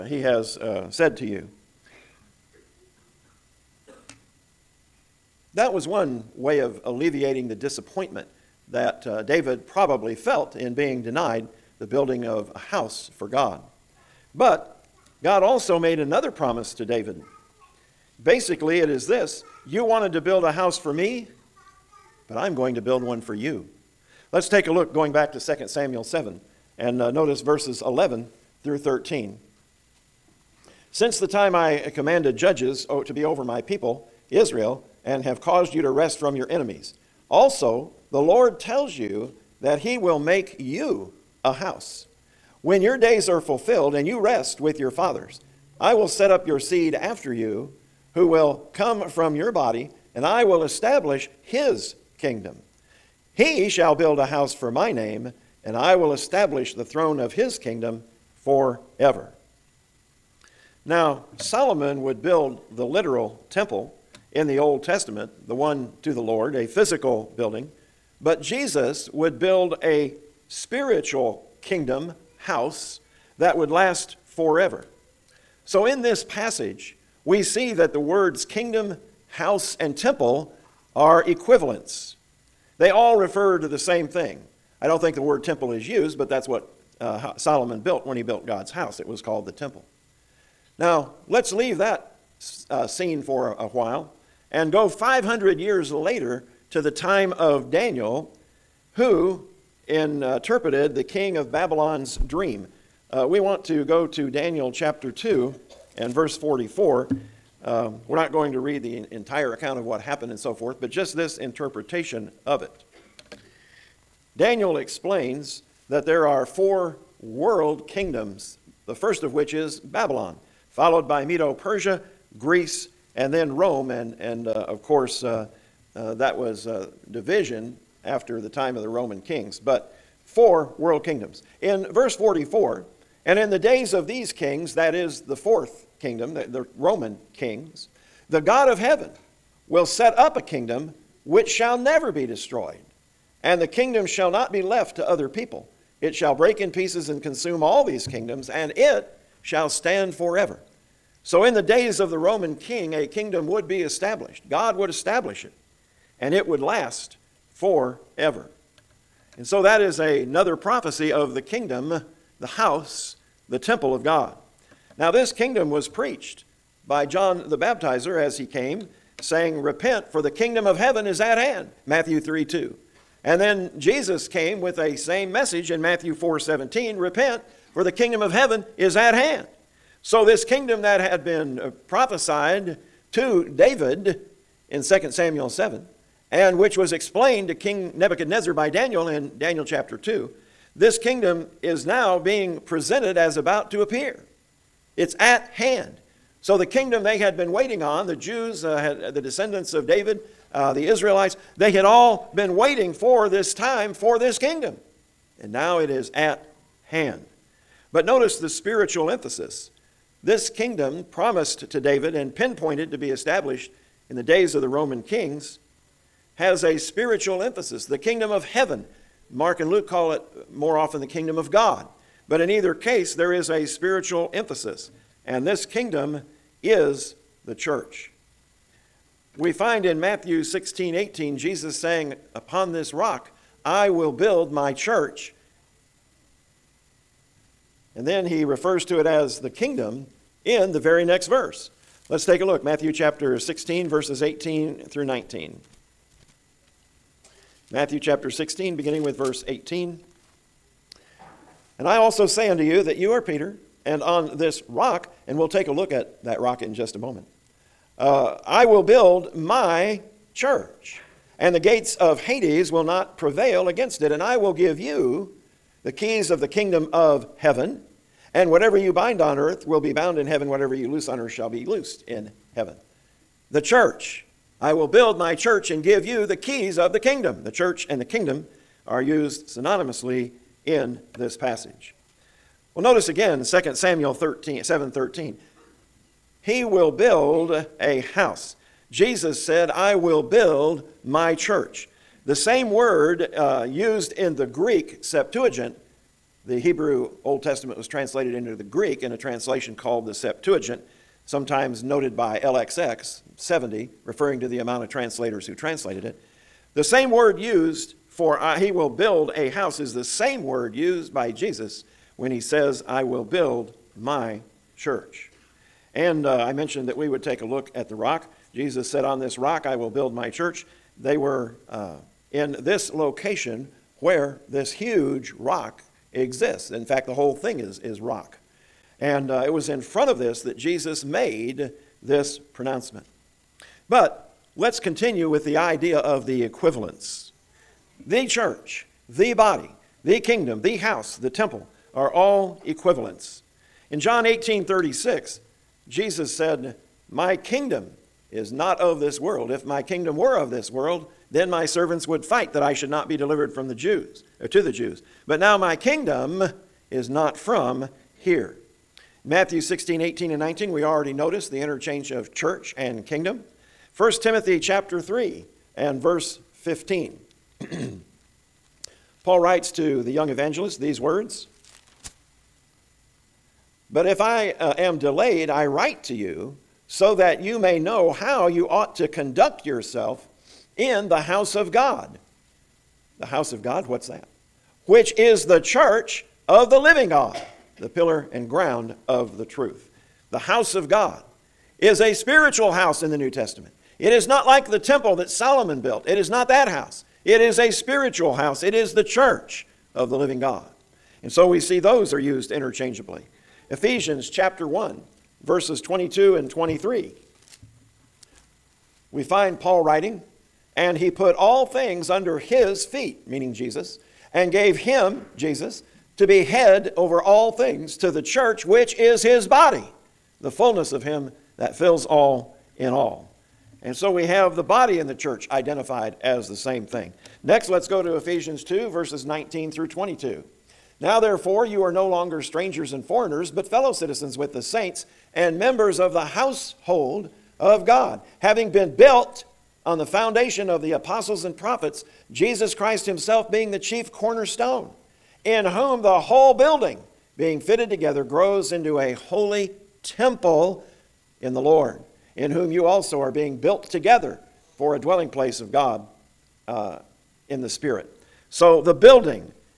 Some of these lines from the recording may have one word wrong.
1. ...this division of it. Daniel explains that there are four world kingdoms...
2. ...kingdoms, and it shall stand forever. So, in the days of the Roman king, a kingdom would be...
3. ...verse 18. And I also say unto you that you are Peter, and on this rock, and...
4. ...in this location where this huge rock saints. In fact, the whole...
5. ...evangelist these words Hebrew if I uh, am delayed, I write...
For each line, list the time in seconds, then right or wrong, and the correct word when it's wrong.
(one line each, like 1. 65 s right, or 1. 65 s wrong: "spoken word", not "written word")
1. 111 s wrong: "interpretation", not "division"
2. 148 s right
3. 249 s right
4. 322 s wrong: "exists", not "saints"
5. 370 s wrong: "But", not "Hebrew".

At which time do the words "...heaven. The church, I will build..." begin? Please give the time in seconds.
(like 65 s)
272 s.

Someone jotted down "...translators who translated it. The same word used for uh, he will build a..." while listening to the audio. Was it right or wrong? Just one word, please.
right.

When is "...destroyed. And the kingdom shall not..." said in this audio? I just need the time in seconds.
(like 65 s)
142 s.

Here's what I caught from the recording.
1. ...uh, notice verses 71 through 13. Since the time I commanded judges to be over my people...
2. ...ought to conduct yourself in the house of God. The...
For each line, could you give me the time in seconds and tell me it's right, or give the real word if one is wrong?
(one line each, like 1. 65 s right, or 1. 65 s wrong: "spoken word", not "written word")
1. 27 s wrong: "11", not "71"
2. 378 s right.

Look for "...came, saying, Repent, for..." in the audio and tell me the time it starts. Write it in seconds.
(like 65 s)
168 s.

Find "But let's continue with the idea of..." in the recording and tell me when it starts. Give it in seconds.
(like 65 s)
333 s.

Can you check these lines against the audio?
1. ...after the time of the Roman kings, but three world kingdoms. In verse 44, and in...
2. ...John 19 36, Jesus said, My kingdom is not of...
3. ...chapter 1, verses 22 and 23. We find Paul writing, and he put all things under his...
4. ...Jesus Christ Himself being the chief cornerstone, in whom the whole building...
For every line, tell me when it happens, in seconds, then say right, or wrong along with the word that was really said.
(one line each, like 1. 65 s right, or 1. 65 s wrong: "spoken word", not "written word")
1. 128 s wrong: "four", not "three"
2. 343 s wrong: "18", not "19"
3. 404 s right
4. 442 s right.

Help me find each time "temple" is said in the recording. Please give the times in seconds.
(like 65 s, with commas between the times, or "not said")
63 s, 79 s, 85 s, 89 s, 163 s, 341 s, 394 s, 450 s.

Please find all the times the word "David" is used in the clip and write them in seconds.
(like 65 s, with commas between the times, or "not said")
9 s, 16 s, 183 s, 199 s, 211 s.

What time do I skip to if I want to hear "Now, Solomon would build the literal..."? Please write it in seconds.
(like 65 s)
60 s.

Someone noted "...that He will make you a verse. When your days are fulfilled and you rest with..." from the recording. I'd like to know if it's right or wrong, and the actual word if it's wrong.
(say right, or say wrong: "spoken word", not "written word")
wrong: "house", not "verse".